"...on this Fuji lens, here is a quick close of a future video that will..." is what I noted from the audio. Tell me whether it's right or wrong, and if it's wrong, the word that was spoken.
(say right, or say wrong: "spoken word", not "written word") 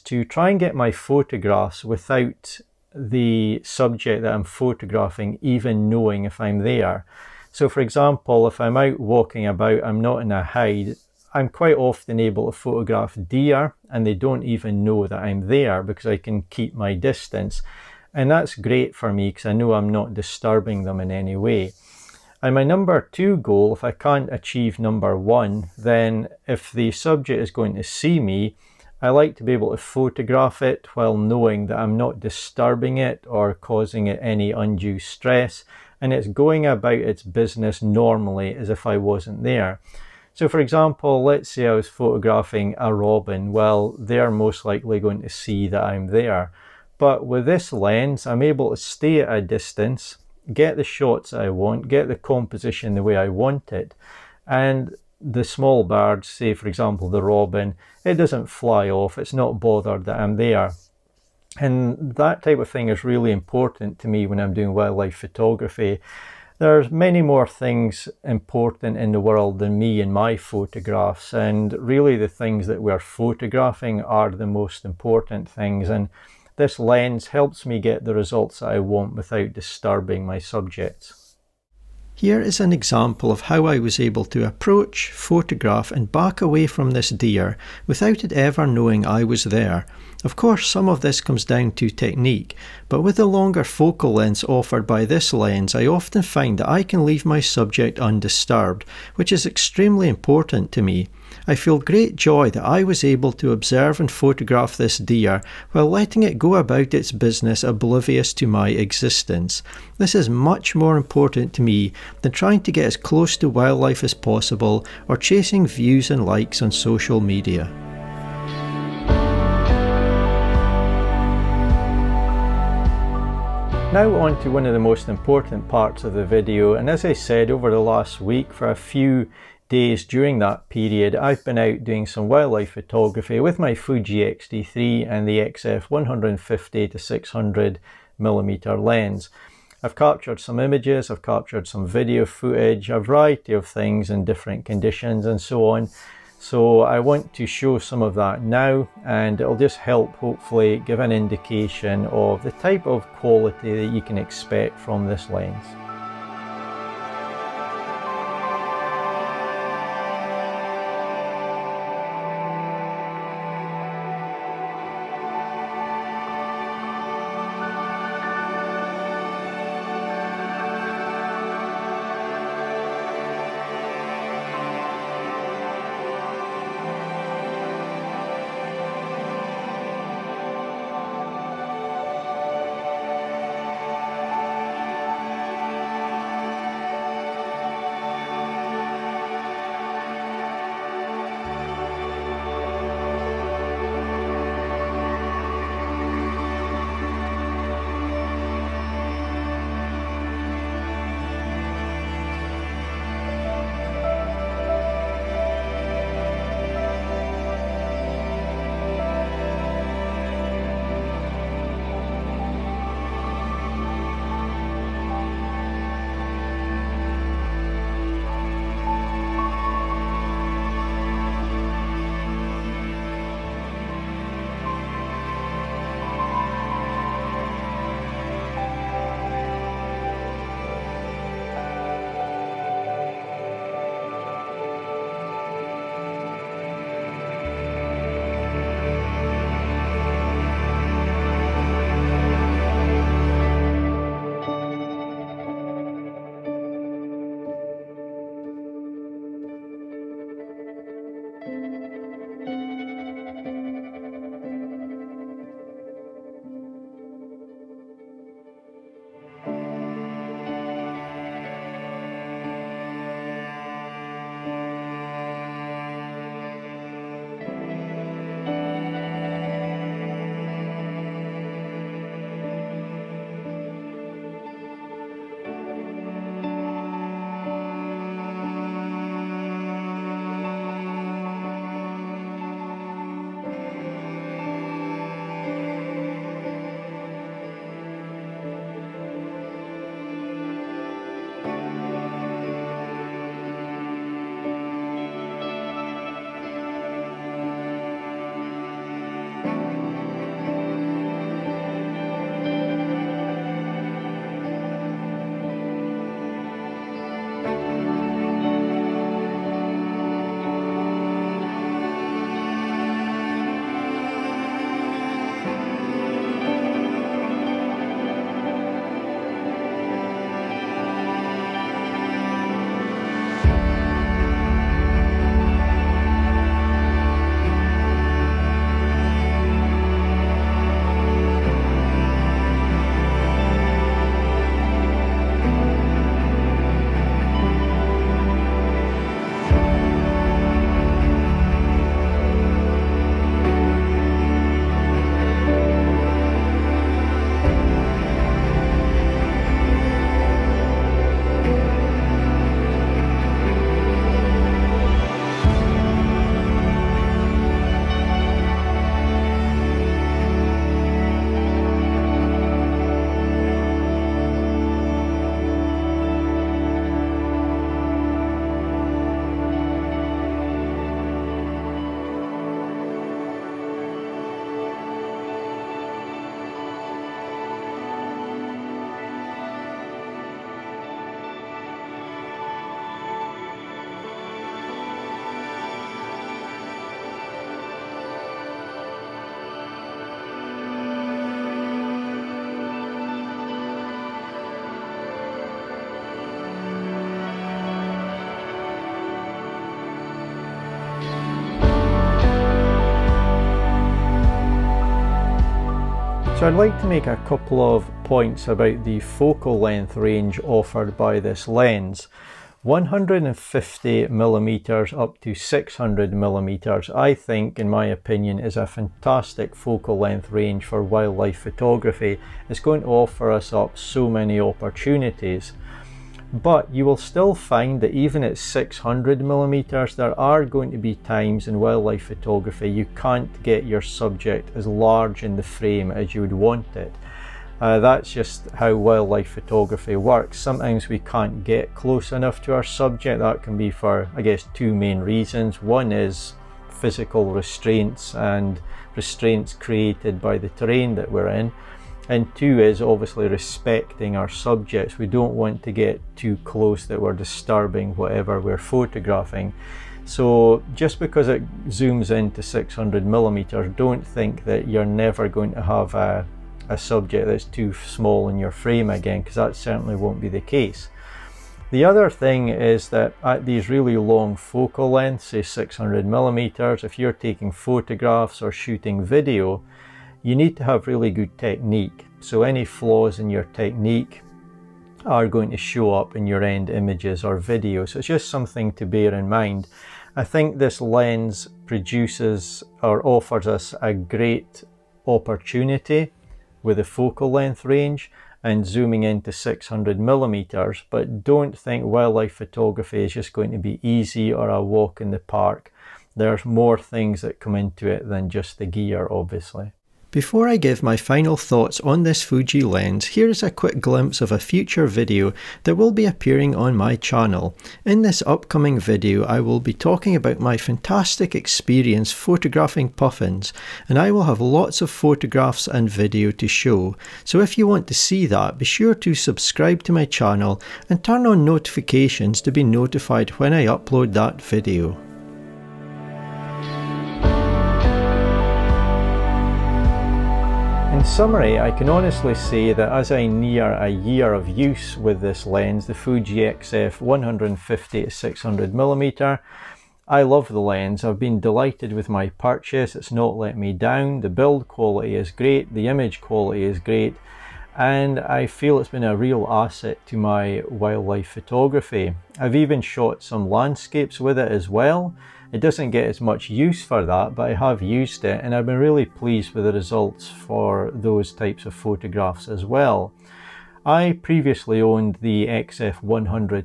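wrong: "glimpse", not "close".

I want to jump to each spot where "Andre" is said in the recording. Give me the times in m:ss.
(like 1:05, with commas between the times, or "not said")
not said.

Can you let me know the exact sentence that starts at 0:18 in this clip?
And that's great for me because I know I'm not disturbing them in any way.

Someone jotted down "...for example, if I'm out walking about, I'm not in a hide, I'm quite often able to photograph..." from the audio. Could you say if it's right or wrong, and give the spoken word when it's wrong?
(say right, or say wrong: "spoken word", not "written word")
right.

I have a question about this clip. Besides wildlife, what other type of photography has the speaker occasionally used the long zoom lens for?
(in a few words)
Landscapes.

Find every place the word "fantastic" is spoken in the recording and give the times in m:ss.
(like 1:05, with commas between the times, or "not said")
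6:58, 8:40.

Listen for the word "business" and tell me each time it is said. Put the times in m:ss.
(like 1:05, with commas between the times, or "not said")
0:37, 1:47.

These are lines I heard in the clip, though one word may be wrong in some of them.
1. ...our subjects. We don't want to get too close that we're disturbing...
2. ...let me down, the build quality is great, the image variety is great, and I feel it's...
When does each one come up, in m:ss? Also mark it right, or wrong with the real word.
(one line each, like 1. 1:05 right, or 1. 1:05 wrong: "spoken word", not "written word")
1. 7:34 right
2. 9:13 wrong: "quality", not "variety".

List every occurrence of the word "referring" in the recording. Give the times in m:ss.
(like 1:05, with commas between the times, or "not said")
not said.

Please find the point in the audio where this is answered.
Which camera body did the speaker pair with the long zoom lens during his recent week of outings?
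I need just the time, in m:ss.
2:13.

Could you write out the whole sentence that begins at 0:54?
And the small birds, say for example the robin, it doesn't fly off, it's not bothered that I'm there.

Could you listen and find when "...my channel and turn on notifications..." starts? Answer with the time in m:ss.
8:49.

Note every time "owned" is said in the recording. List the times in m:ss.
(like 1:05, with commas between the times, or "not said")
9:34.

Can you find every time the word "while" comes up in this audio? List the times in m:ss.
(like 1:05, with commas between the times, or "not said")
0:30, 1:45.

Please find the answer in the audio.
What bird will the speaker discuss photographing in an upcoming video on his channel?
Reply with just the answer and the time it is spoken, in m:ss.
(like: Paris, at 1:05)
Puffins, at 8:42.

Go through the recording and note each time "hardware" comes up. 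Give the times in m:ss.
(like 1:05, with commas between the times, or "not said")
not said.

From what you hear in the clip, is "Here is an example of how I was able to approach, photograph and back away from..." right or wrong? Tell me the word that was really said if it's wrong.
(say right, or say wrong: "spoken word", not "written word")
right.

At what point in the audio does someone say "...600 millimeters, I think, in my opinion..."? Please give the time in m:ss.
6:55.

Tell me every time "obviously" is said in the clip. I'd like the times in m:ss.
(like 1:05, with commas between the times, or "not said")
7:32, 8:29.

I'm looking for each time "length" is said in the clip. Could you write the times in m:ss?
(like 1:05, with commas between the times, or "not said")
1:34, 6:49, 6:59, 7:54, 8:17.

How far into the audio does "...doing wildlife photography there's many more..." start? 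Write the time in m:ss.
1:04.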